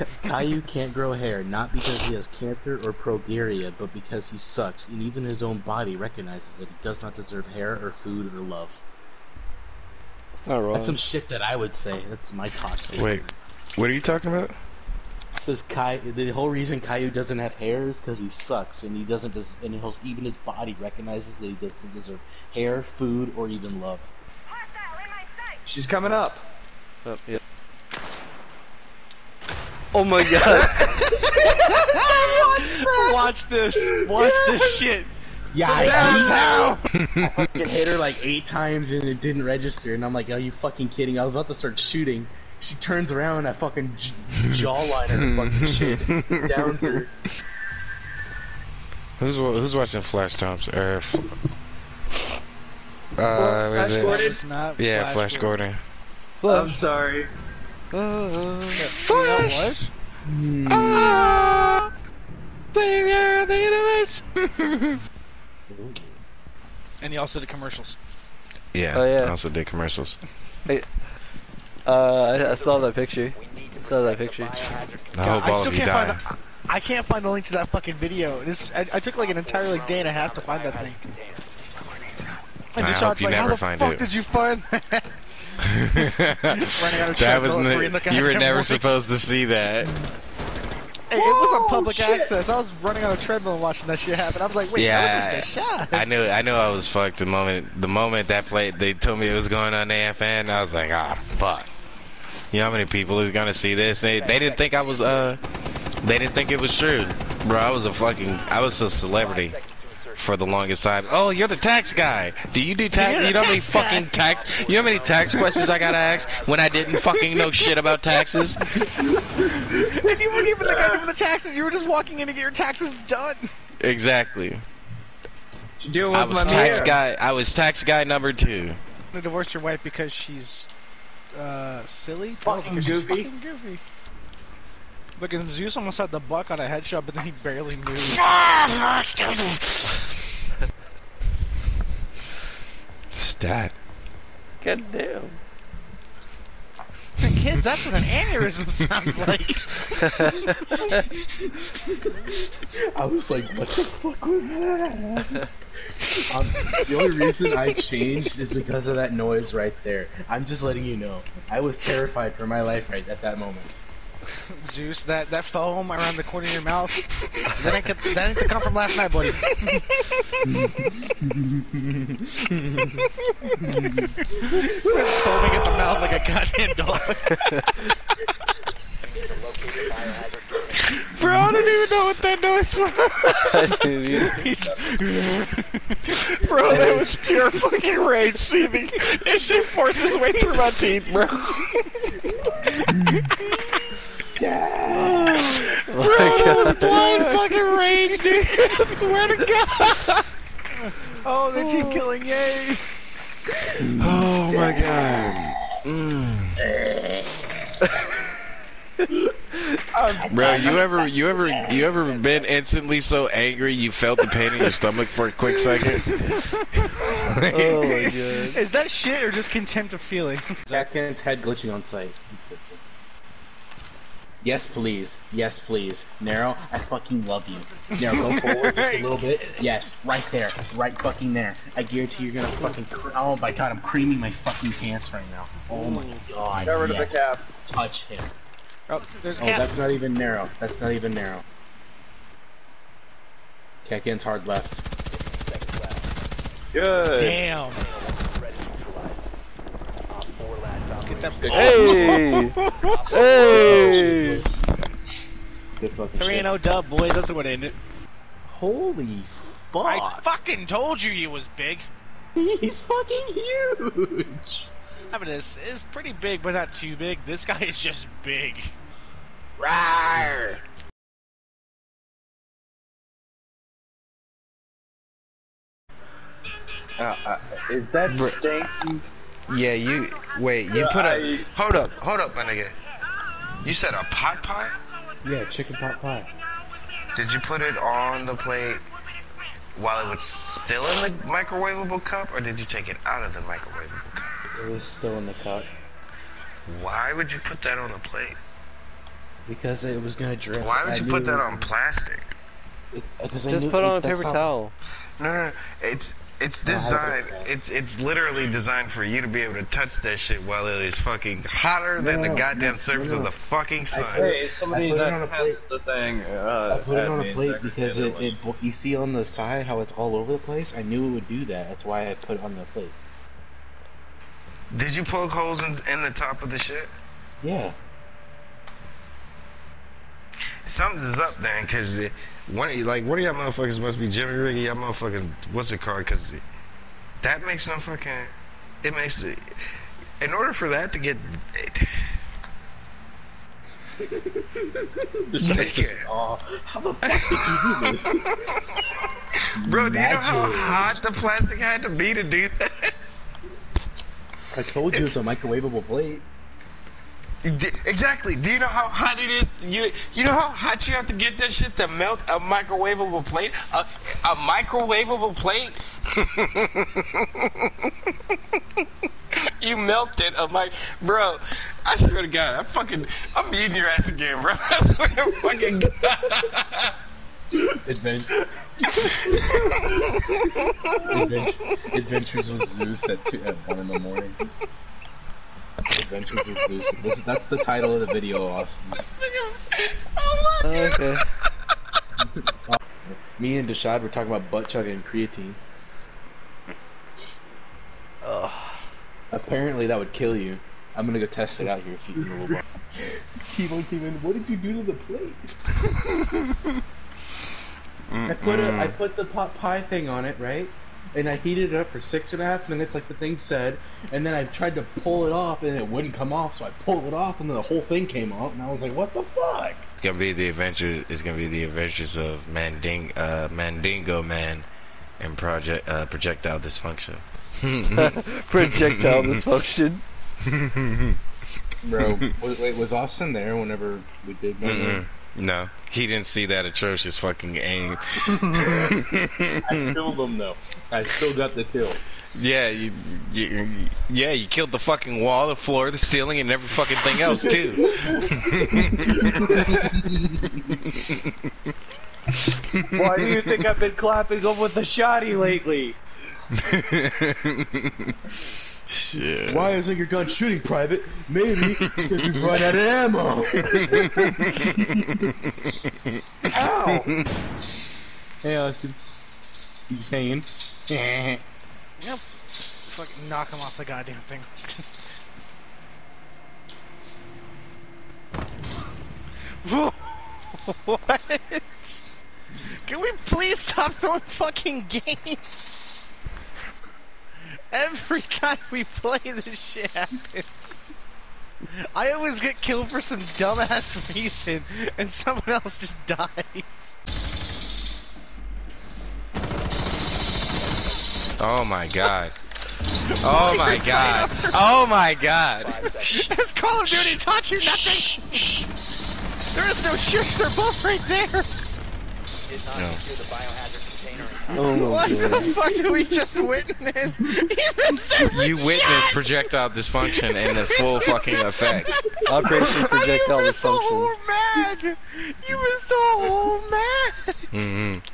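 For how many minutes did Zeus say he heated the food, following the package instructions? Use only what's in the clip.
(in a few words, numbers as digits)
6 and a half.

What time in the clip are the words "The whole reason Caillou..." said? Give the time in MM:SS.
00:15.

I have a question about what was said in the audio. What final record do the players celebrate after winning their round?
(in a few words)
3 and 0.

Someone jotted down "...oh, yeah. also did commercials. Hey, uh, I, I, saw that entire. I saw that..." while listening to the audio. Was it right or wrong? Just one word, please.
wrong.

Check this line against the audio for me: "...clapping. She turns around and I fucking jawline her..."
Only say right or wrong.
wrong.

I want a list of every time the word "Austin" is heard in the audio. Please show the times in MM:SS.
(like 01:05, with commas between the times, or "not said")
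06:28, 07:12, 07:48.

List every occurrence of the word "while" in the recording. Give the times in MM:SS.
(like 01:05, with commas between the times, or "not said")
04:49, 05:10.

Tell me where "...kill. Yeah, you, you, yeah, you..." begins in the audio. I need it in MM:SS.
07:21.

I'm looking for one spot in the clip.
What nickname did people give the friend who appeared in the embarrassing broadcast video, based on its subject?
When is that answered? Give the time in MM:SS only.
01:51.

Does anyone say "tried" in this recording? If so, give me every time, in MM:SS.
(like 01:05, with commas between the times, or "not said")
06:54.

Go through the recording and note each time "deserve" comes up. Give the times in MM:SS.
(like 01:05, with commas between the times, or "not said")
00:07, 00:21.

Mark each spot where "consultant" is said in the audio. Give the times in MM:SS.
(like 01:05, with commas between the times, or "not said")
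not said.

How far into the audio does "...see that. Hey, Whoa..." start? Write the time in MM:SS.
01:29.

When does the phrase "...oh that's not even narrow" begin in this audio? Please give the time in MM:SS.
03:59.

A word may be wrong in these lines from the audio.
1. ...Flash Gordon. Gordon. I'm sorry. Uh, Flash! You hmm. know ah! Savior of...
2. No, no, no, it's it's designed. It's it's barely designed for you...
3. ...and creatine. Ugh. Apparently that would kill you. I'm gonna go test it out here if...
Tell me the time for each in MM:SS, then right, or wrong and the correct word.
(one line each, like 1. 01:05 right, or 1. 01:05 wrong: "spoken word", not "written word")
1. 00:55 right
2. 05:05 wrong: "literally", not "barely"
3. 06:34 right.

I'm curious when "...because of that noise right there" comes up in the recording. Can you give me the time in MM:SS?
02:38.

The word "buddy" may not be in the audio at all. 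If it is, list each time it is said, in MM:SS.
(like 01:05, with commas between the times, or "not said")
02:49.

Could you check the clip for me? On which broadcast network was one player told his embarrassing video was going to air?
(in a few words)
AFN.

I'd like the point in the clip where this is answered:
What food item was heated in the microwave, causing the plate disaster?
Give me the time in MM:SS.
04:45.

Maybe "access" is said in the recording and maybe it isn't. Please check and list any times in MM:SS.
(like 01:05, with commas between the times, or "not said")
01:32.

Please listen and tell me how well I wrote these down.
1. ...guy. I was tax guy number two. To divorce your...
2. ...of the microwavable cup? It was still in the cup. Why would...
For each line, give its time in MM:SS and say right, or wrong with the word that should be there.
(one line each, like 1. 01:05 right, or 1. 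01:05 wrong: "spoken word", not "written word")
1. 02:06 right
2. 04:53 right.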